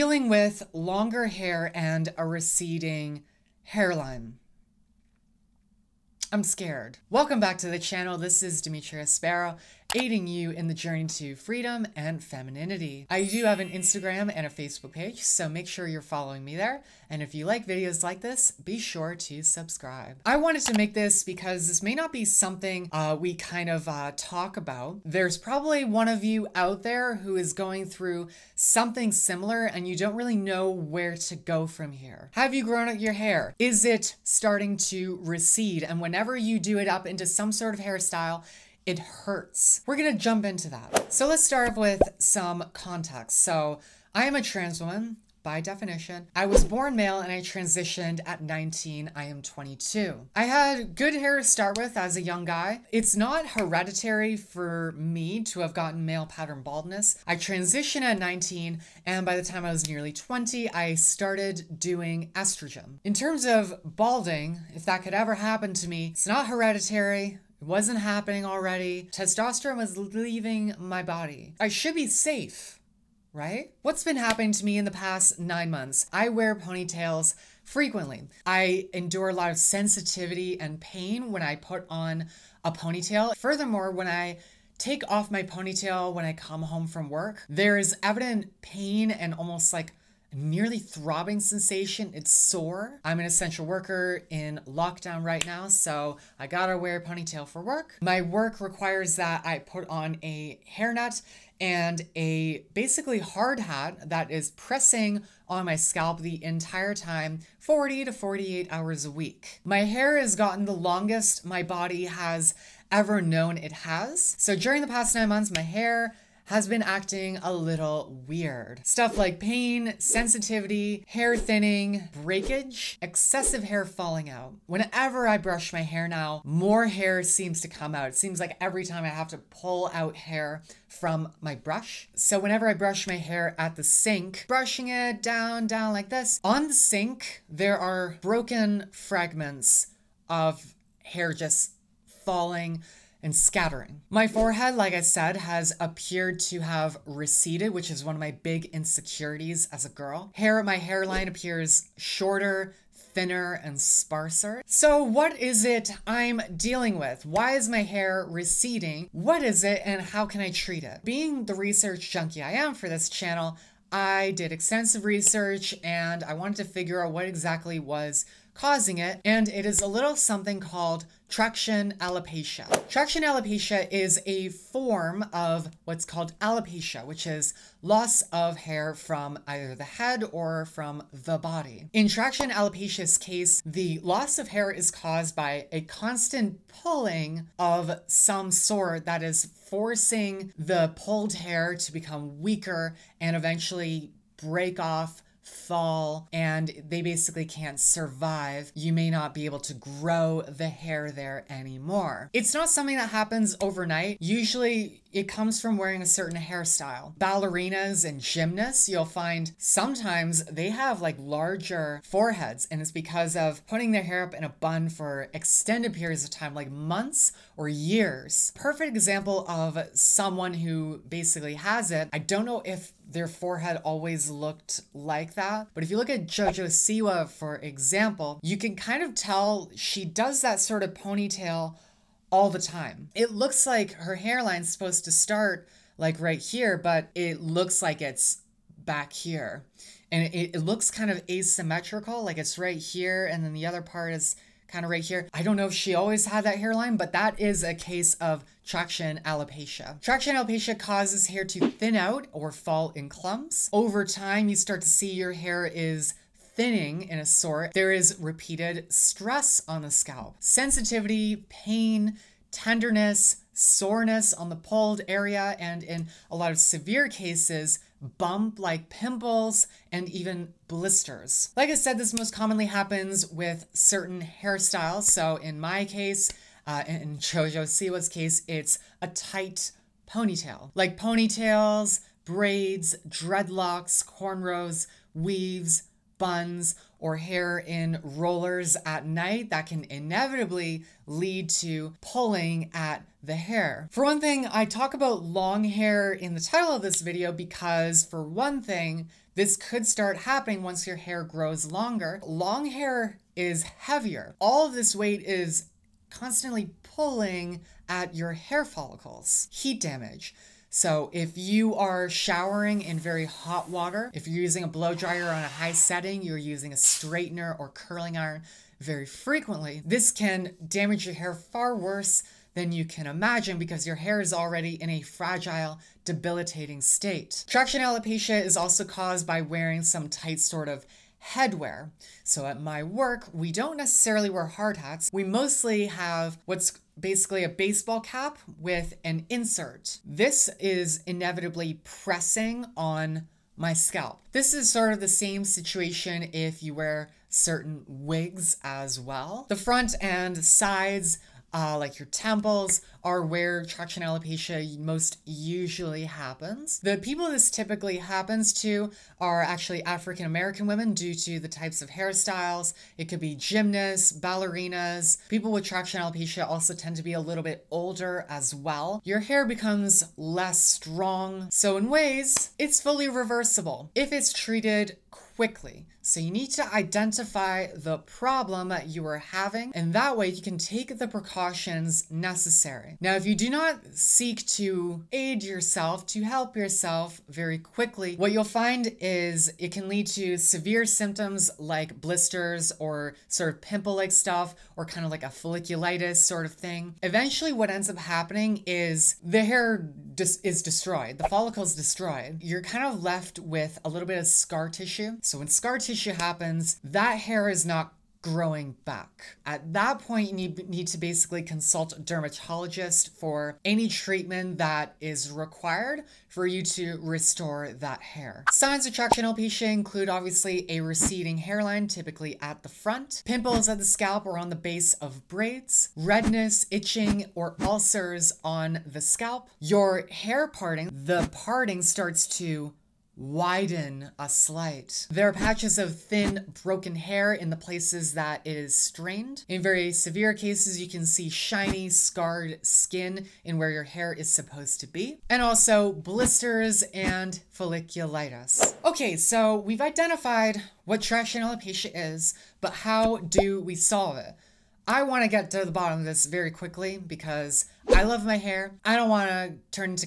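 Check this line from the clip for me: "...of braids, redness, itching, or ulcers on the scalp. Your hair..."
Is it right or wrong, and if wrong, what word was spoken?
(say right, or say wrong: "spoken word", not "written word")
right.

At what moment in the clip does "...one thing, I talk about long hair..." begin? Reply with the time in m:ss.
4:54.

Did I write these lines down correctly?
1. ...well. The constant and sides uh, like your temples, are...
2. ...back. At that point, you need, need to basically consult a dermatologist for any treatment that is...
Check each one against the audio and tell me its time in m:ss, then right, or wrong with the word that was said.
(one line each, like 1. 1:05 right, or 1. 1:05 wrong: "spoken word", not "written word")
1. 5:48 wrong: "front", not "constant"
2. 6:48 right.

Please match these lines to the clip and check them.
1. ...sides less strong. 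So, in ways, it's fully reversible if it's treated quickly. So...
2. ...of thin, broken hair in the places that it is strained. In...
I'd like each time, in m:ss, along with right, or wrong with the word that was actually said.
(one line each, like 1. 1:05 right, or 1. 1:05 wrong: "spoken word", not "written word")
1. 6:09 wrong: "becomes", not "sides"
2. 7:15 right.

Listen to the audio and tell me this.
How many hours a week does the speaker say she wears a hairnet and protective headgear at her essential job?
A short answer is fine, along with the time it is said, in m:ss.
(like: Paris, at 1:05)
40 to 48, at 1:47.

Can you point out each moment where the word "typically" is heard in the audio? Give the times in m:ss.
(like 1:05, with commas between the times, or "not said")
5:57, 7:01.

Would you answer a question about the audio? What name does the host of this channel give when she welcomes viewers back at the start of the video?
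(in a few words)
Dimitria Sparrow.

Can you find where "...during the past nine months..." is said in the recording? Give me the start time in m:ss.
1:54.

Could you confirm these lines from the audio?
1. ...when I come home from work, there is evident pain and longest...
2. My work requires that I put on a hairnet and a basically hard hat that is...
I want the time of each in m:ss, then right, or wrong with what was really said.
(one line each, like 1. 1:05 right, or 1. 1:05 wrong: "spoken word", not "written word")
1. 1:26 wrong: "almost", not "longest"
2. 1:38 right.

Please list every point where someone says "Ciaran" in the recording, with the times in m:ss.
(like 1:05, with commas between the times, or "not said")
not said.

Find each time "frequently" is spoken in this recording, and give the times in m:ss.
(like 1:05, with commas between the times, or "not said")
1:17, 5:19.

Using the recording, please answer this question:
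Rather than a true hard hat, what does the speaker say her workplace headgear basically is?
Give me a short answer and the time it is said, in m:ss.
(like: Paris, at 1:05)
Baseball cap with an insert, at 5:37.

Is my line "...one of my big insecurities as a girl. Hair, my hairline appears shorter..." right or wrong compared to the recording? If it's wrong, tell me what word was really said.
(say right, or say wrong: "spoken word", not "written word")
right.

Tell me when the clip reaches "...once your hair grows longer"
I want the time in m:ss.
5:00.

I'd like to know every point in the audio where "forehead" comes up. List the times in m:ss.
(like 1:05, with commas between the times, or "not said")
2:24, 3:32, 3:43.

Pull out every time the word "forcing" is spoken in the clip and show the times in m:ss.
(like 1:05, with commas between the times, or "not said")
3:09.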